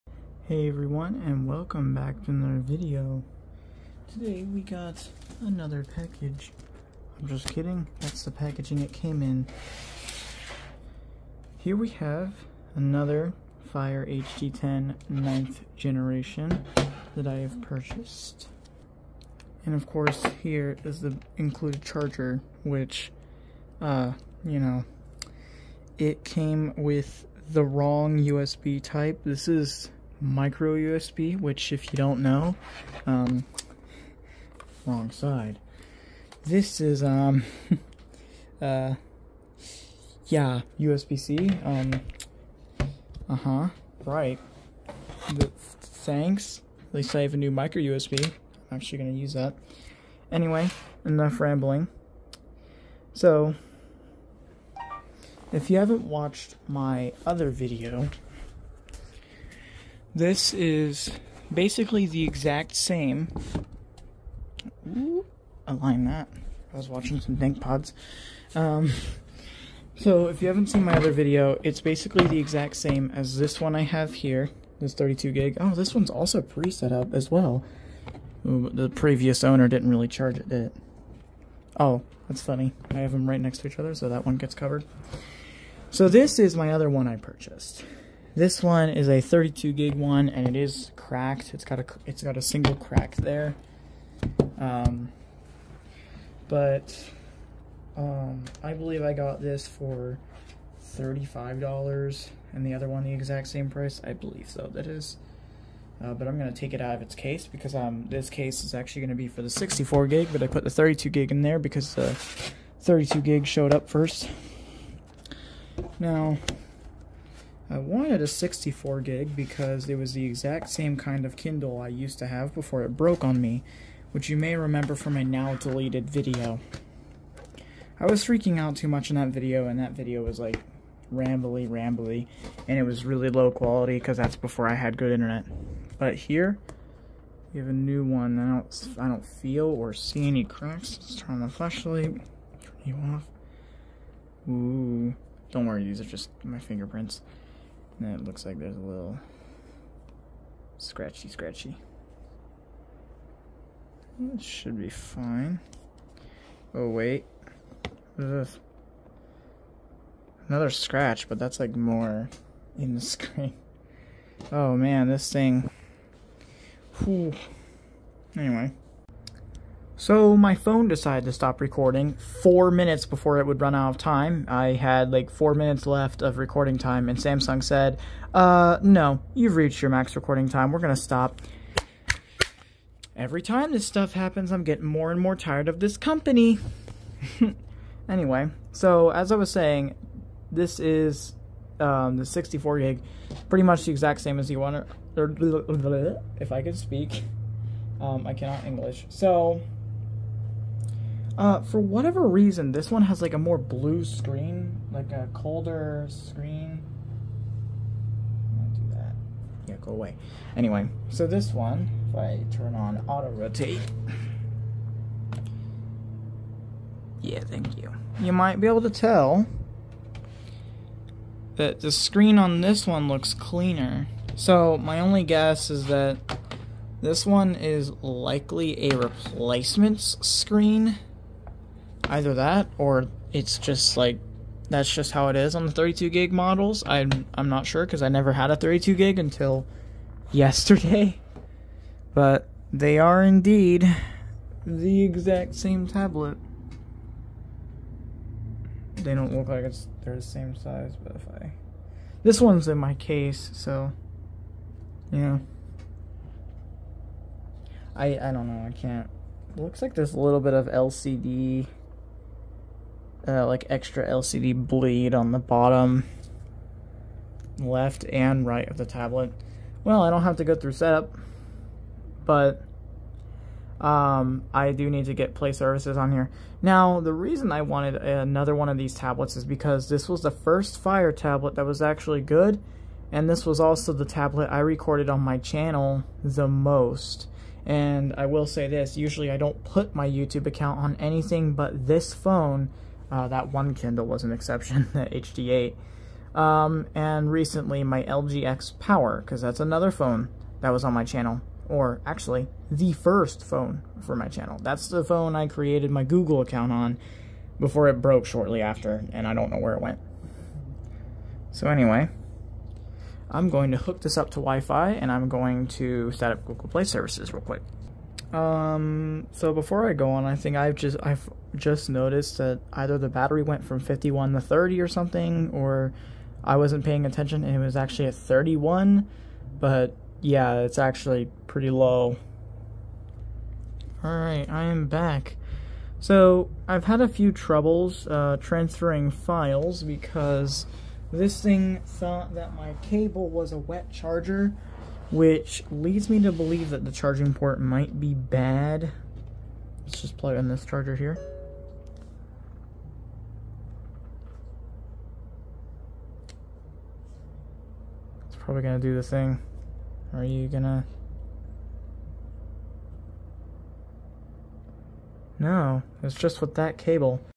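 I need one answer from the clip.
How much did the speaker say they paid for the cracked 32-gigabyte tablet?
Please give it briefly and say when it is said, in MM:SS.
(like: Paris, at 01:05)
$35, at 01:40.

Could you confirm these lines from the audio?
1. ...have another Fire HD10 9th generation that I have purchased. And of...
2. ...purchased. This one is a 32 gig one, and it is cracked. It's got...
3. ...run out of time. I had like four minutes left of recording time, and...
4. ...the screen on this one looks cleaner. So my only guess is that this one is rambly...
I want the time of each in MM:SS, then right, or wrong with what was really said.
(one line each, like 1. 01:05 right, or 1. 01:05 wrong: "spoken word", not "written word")
1. 00:11 right
2. 01:27 right
3. 02:53 right
4. 03:41 wrong: "likely", not "rambly".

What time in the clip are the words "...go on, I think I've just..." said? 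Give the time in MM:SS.
05:19.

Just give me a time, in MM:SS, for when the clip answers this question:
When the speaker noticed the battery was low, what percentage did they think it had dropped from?
05:23.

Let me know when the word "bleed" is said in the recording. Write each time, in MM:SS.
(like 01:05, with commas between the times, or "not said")
04:24.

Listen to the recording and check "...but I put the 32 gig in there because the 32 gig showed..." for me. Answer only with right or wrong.
right.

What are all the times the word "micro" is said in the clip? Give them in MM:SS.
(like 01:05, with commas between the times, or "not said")
00:30, 00:47.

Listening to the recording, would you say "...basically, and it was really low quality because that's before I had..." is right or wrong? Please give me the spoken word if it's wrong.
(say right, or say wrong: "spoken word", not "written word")
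wrong: "rambly", not "basically".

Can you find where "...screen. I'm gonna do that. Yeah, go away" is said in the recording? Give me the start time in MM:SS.
03:26.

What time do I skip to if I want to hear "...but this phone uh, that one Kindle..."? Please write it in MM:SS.
04:51.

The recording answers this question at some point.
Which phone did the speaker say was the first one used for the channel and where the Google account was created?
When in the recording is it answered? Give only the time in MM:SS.
04:58.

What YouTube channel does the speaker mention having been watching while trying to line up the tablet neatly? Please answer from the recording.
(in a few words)
DankPods.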